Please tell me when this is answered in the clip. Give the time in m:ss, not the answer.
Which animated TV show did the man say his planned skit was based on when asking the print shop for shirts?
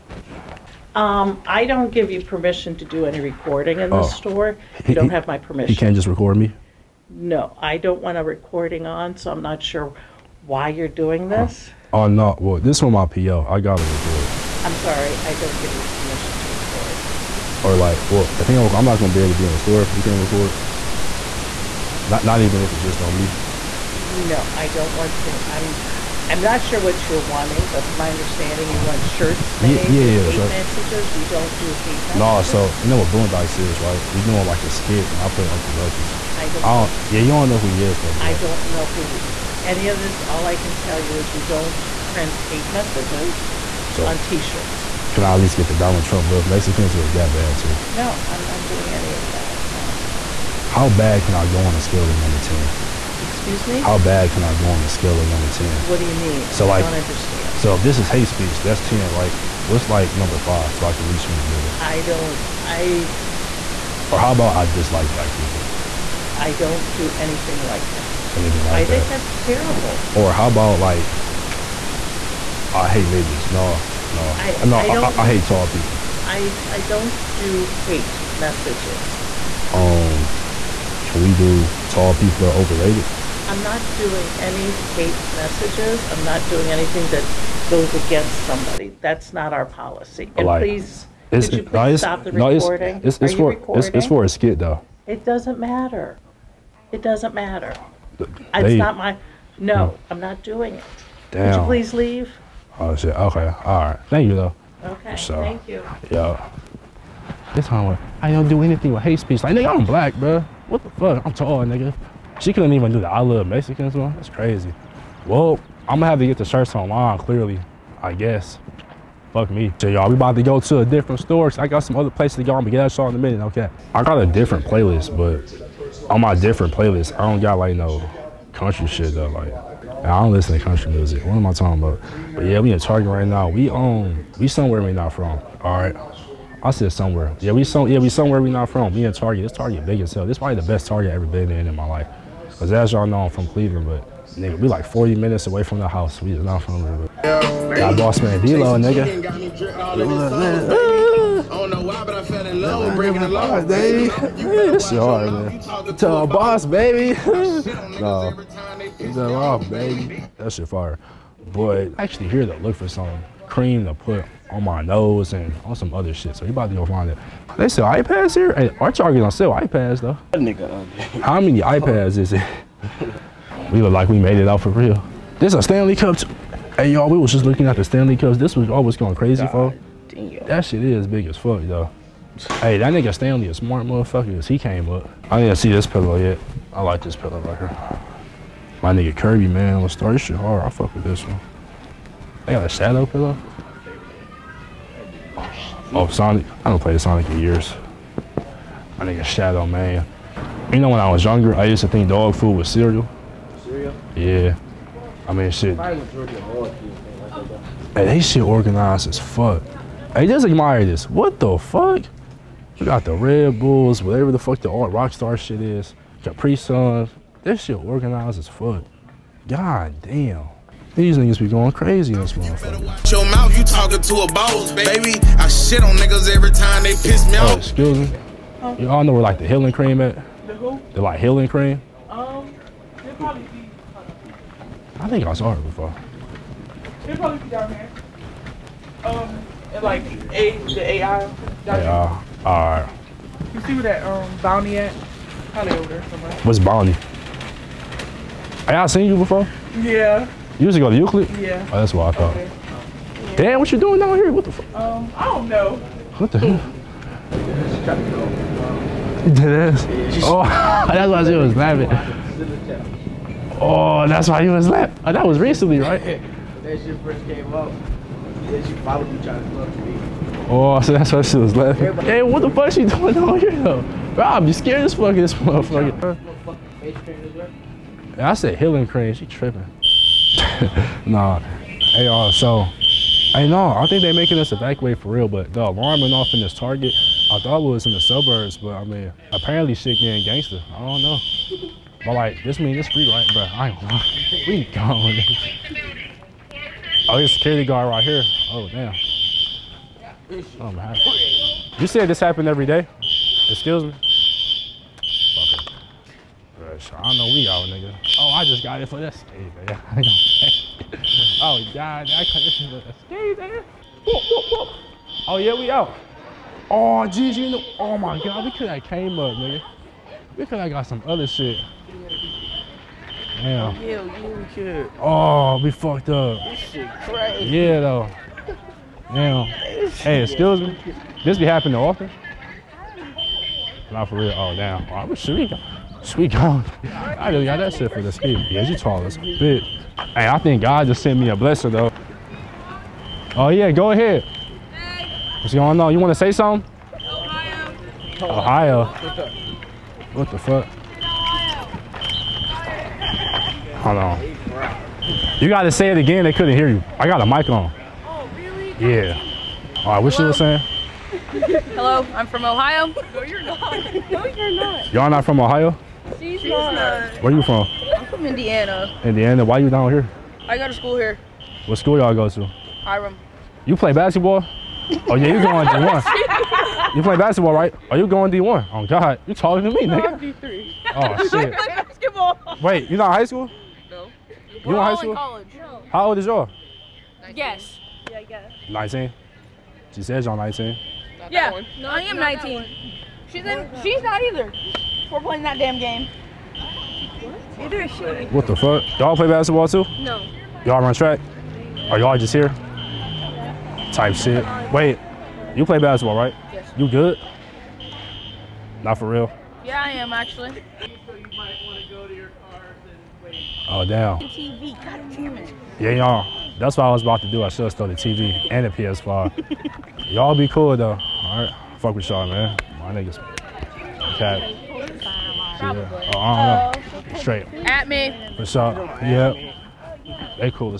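0:33.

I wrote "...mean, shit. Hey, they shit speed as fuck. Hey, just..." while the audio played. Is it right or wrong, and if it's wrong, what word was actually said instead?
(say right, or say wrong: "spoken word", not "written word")
wrong: "organized", not "speed".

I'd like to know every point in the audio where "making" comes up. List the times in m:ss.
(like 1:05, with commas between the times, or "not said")
4:44.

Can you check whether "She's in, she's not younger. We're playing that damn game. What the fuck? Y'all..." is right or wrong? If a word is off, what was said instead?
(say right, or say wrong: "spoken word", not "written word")
wrong: "either", not "younger".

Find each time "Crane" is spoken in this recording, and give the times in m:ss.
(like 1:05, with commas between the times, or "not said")
4:38.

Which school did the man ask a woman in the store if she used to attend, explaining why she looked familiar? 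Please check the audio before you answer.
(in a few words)
Euclid.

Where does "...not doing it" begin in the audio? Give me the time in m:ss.
1:40.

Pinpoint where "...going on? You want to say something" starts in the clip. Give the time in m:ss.
5:45.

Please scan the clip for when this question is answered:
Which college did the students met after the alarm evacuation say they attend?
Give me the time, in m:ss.
6:12.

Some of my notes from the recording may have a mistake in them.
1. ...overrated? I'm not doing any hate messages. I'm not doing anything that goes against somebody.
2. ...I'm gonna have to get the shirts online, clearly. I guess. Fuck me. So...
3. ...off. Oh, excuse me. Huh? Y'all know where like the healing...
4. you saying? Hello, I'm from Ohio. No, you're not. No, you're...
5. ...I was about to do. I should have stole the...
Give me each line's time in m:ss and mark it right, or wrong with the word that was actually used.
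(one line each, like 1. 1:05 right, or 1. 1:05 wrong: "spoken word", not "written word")
1. 1:22 right
2. 1:55 right
3. 3:47 right
4. 6:00 right
5. 6:56 right.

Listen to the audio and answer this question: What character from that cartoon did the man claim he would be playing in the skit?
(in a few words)
Uncle Ruckus.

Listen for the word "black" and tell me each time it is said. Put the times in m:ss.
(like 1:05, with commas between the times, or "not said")
1:05, 1:49.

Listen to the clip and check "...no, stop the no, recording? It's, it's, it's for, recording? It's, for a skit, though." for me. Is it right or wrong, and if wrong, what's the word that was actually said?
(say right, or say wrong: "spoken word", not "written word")
right.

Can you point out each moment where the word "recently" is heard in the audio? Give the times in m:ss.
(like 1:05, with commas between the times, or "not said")
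4:25.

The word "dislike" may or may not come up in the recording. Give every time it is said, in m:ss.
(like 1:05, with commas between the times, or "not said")
1:04.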